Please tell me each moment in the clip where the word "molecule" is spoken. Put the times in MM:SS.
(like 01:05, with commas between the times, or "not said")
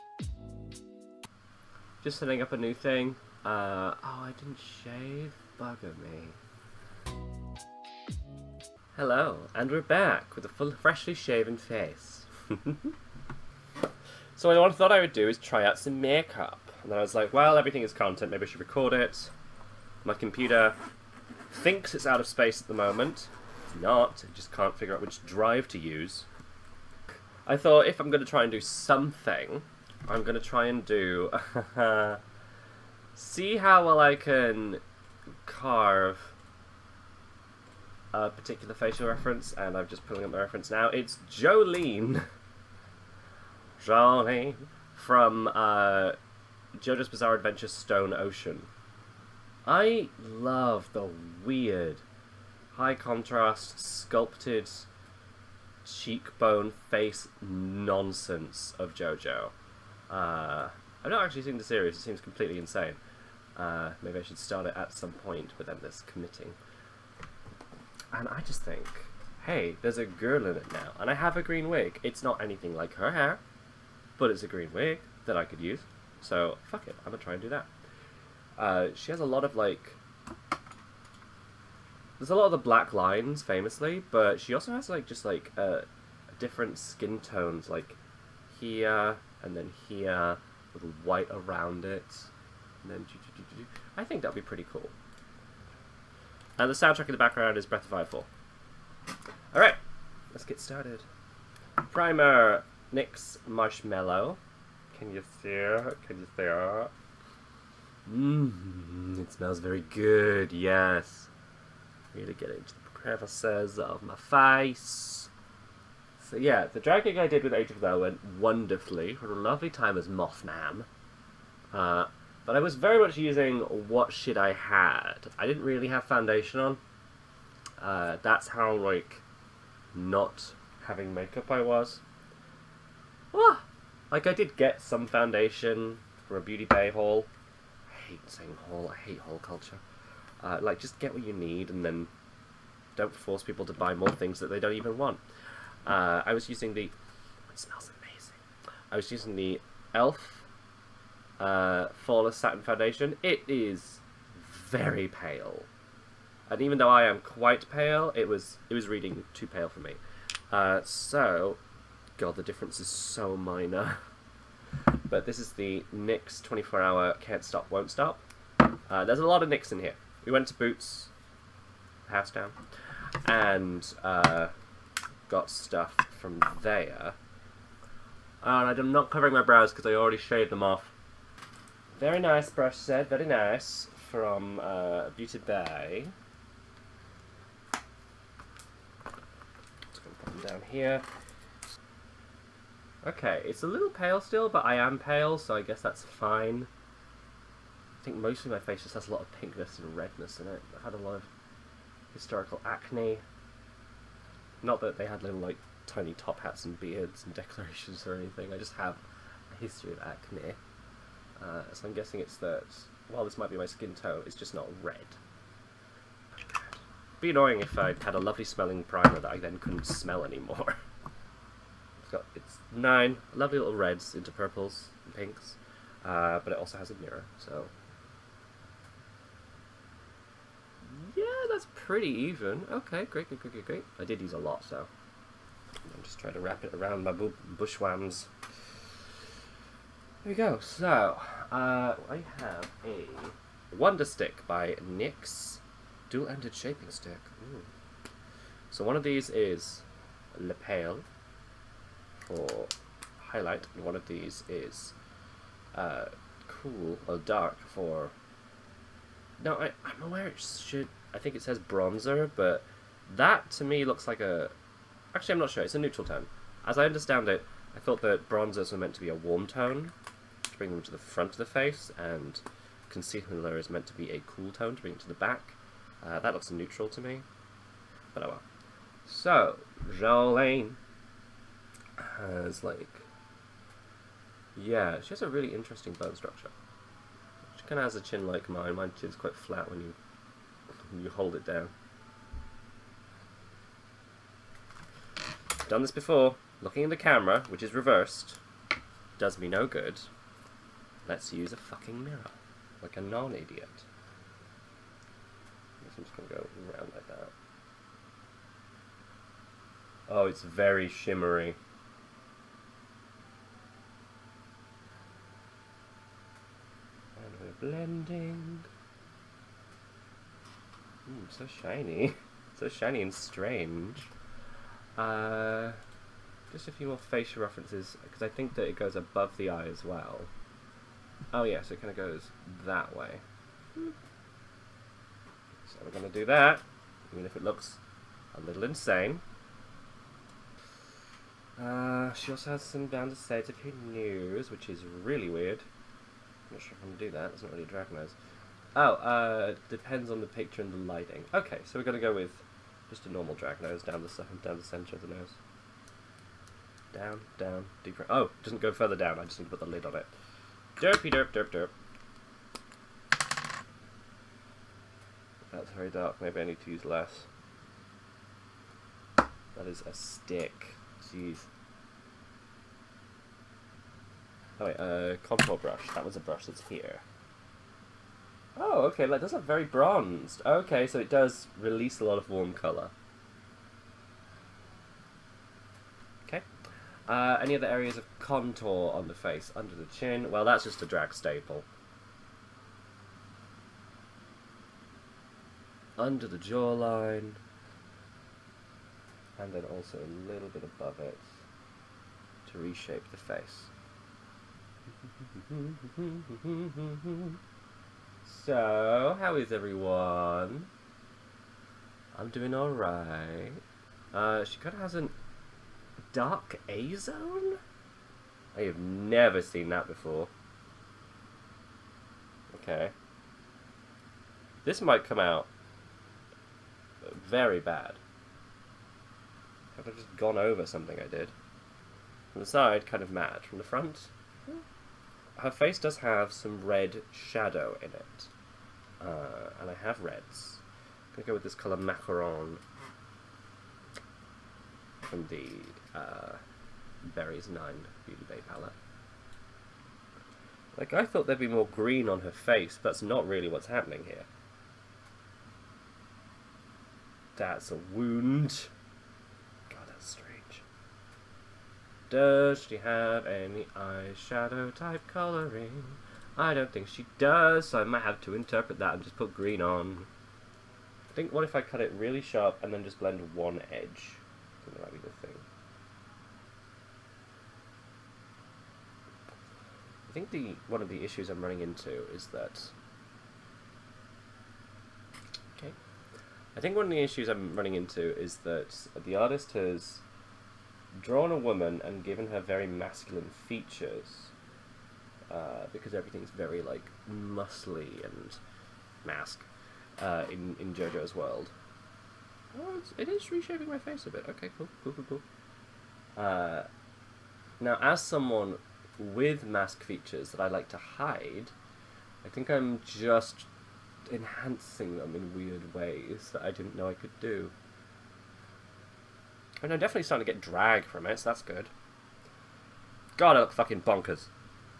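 not said.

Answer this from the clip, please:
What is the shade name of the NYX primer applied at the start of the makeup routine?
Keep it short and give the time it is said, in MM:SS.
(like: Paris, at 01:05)
Marshmallow, at 01:42.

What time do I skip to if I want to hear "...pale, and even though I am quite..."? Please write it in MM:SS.
02:35.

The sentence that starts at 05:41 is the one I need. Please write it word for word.
Uh, she also has some down to say to news, which is really weird.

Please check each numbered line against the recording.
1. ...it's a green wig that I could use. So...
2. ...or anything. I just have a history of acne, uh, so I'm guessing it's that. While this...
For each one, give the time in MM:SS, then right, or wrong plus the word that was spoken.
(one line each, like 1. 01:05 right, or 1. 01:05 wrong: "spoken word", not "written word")
1. 01:14 right
2. 03:28 right.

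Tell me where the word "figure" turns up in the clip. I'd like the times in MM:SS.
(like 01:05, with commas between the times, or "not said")
00:24.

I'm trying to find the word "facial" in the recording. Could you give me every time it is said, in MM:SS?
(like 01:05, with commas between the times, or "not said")
00:38, 05:26.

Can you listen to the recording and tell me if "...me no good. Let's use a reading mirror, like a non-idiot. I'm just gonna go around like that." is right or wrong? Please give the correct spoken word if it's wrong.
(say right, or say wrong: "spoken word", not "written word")
wrong: "fucking", not "reading".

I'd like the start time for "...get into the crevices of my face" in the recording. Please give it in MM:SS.
01:52.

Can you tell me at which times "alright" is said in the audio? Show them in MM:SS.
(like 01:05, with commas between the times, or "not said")
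01:39, 06:52.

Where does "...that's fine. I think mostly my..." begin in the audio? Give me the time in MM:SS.
03:15.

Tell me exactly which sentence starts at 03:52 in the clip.
Okay, great, great, great, great, great.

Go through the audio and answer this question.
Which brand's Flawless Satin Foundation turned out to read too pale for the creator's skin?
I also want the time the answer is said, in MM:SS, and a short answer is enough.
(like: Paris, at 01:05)
Elf, at 02:29.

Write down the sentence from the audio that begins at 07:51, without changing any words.
I think what if I cut it really sharp and then just blend one edge?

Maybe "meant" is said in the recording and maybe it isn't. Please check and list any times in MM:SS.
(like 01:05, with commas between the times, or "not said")
04:28, 04:33.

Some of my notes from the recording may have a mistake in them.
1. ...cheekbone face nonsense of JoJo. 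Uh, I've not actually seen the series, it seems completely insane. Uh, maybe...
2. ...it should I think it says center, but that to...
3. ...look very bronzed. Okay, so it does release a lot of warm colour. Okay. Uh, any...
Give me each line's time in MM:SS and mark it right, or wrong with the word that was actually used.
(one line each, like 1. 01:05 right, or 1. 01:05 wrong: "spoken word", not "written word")
1. 00:55 right
2. 04:20 wrong: "bronzer", not "center"
3. 06:19 right.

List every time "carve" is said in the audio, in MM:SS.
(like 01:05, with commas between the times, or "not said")
00:35.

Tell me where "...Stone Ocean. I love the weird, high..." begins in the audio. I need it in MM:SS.
00:47.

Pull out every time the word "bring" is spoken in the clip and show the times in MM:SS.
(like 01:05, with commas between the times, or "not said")
04:30, 04:34.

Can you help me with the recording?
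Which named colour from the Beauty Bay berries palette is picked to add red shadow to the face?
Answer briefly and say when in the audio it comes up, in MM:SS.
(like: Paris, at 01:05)
Macaron, at 07:21.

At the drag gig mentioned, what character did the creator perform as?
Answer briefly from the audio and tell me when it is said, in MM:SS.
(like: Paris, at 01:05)
Mothman, at 02:00.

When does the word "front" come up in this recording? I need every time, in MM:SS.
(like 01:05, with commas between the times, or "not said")
04:30, 07:13.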